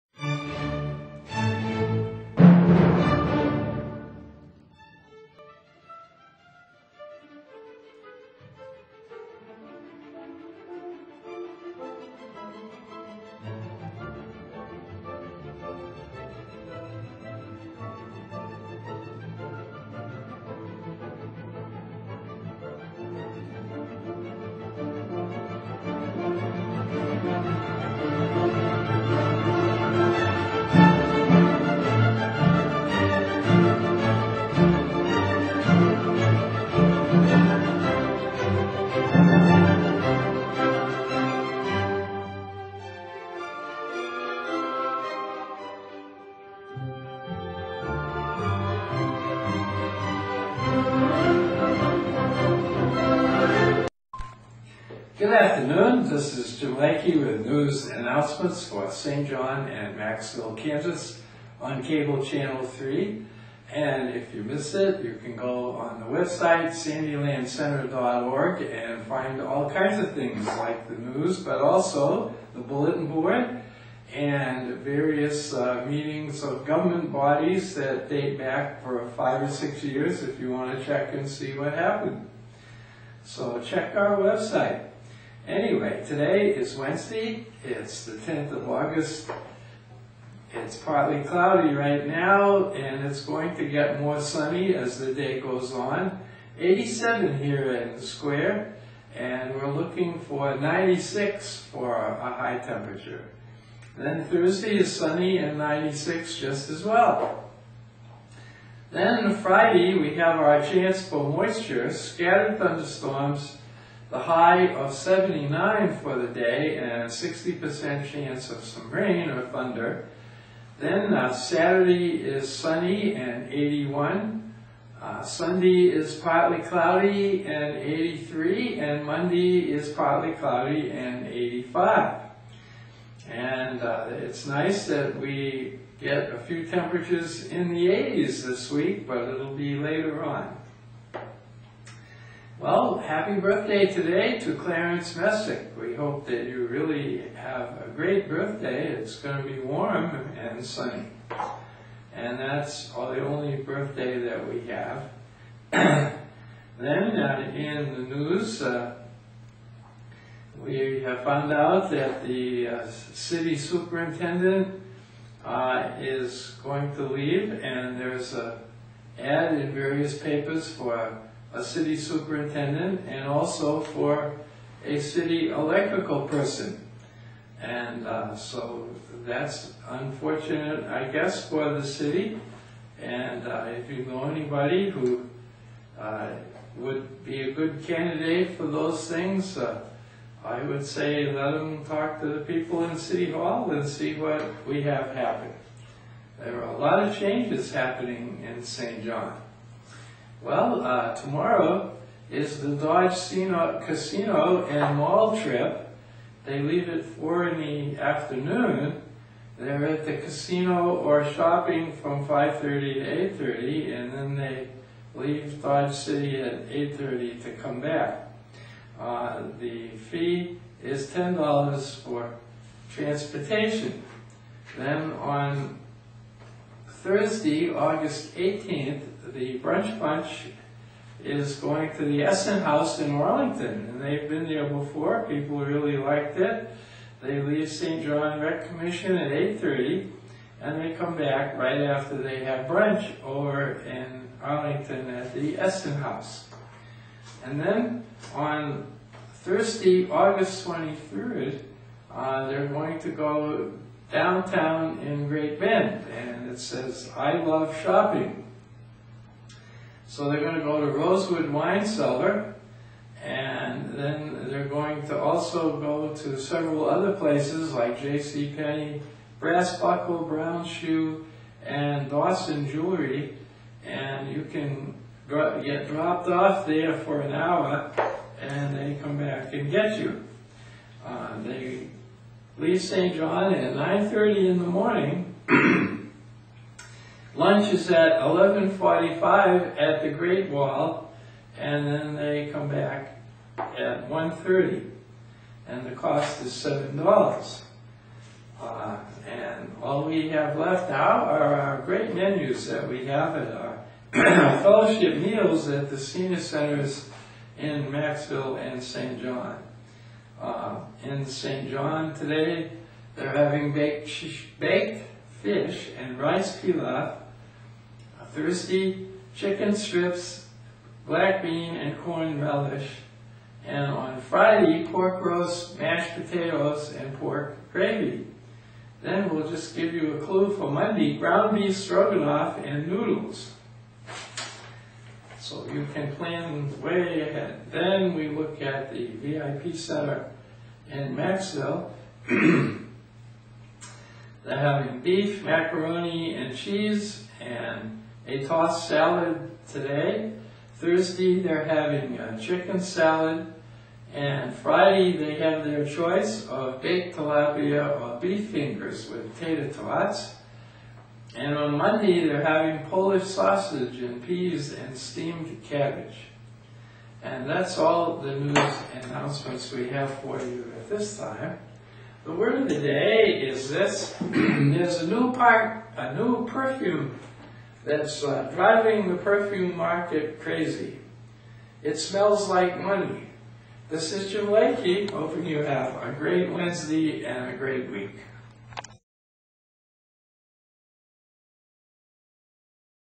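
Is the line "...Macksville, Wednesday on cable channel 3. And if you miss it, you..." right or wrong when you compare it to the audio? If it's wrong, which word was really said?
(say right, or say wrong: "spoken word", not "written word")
wrong: "Kansas", not "Wednesday".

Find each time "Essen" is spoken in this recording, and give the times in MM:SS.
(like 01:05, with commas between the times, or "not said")
03:52, 04:05.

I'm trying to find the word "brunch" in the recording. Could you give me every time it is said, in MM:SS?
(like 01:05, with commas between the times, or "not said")
03:49, 04:02.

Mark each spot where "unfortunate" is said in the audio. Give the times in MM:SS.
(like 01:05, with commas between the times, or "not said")
02:59.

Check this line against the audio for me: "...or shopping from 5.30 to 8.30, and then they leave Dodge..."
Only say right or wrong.
right.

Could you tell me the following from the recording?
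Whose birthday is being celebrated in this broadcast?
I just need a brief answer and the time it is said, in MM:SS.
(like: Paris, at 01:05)
Clarence Messick, at 02:24.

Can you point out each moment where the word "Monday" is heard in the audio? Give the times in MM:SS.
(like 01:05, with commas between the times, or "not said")
02:09, 05:30, 06:01.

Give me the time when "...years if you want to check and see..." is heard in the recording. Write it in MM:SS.
01:19.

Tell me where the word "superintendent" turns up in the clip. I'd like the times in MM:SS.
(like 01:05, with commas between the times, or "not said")
02:43, 02:51.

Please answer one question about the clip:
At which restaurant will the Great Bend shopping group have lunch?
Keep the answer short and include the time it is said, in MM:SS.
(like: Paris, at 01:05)
Great Wall, at 04:50.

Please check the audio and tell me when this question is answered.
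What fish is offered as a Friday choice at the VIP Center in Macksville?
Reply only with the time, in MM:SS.
05:57.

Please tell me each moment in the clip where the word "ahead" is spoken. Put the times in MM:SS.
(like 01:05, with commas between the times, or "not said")
05:37.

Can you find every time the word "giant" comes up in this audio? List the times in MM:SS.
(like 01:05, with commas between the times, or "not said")
not said.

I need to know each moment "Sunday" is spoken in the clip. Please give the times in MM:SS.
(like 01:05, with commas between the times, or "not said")
02:05.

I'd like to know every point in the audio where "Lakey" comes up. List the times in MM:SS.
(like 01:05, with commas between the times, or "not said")
00:56, 06:24.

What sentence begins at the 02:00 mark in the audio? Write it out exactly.
Then uh, Saturday is sunny and 81.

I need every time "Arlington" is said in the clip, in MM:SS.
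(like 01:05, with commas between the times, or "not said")
03:53, 04:04.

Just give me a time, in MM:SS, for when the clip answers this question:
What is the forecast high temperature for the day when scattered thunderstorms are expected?
01:54.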